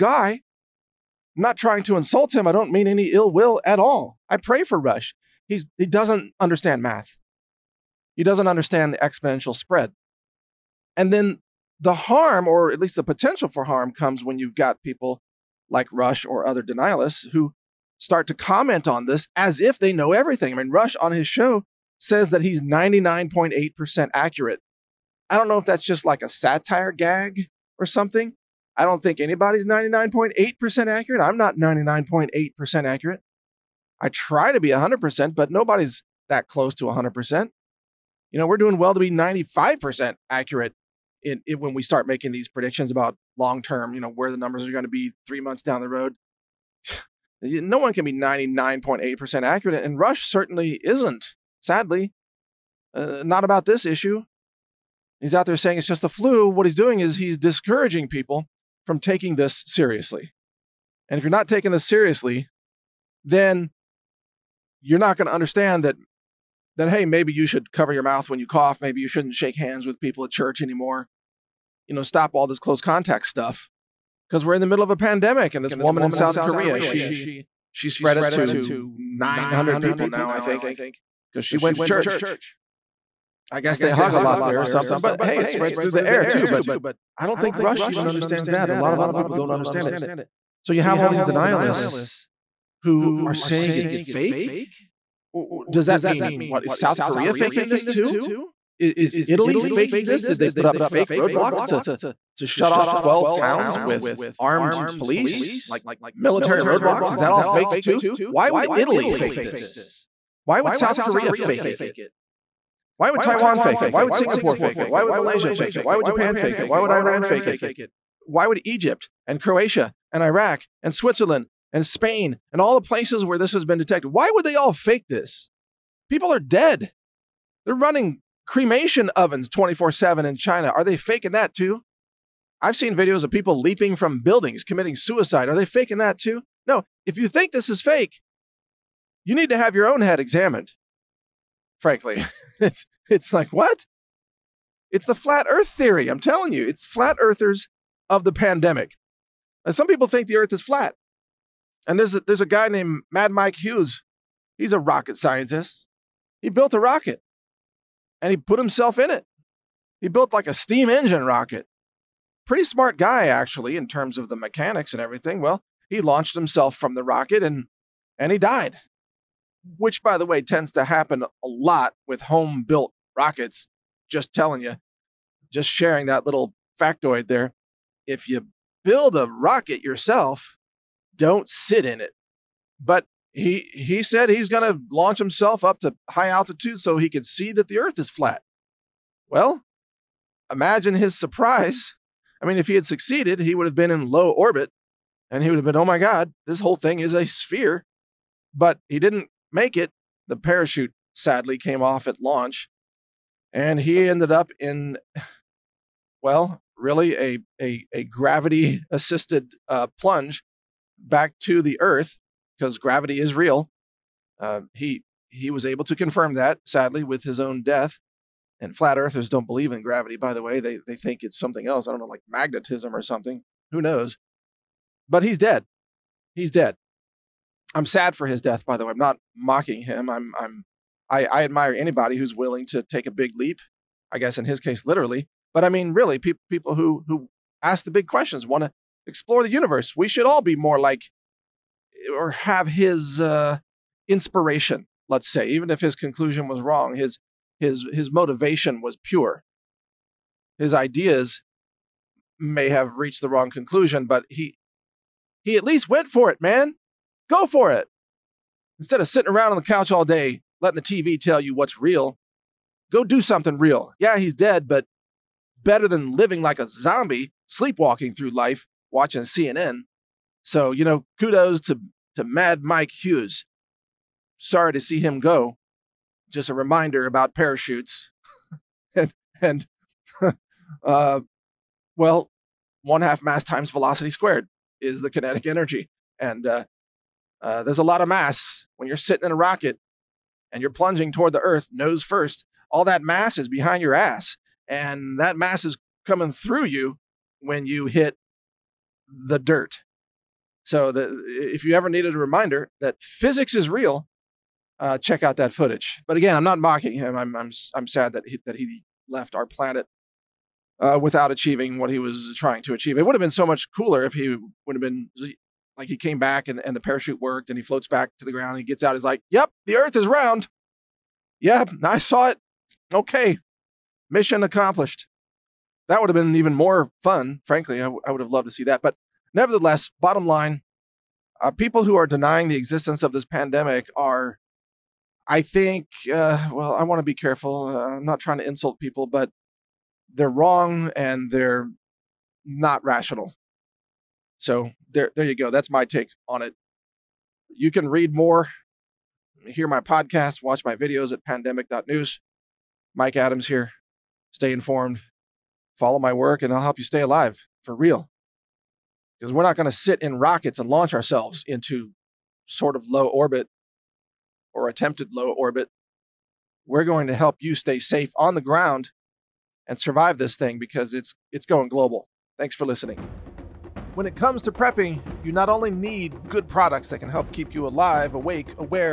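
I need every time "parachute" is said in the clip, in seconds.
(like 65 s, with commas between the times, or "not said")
200 s, 277 s, 316 s.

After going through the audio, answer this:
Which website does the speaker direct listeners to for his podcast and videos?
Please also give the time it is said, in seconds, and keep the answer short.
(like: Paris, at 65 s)
pandemic.news, at 351 s.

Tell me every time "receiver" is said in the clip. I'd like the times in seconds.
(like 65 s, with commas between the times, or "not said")
not said.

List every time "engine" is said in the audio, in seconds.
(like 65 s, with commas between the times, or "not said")
160 s.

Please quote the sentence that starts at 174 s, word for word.
Just telling you, just sharing that little factoid there.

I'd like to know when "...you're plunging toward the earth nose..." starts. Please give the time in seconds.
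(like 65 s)
290 s.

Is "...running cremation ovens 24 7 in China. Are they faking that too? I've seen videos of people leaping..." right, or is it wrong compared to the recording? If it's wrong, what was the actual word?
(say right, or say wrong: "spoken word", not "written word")
right.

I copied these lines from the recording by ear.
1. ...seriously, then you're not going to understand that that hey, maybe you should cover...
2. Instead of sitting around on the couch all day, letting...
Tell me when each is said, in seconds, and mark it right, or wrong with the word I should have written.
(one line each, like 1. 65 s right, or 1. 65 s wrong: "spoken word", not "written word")
1. 61 s right
2. 258 s right.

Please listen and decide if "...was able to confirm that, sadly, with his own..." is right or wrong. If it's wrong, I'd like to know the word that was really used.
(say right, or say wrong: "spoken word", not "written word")
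right.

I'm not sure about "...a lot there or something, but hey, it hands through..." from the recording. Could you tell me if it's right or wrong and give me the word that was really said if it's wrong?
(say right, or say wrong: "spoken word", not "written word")
wrong: "spreads", not "hands".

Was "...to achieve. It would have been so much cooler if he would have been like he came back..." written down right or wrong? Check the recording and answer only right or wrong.
right.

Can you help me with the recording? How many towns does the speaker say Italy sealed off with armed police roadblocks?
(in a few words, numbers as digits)
12.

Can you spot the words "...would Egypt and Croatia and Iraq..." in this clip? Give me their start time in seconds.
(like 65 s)
118 s.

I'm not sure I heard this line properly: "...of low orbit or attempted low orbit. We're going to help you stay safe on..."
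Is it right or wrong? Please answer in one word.
right.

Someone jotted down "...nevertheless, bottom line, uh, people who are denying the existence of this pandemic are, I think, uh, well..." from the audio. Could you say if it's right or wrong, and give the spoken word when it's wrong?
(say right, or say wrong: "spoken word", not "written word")
right.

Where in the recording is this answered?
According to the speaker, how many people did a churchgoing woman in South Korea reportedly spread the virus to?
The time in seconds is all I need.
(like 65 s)
78 s.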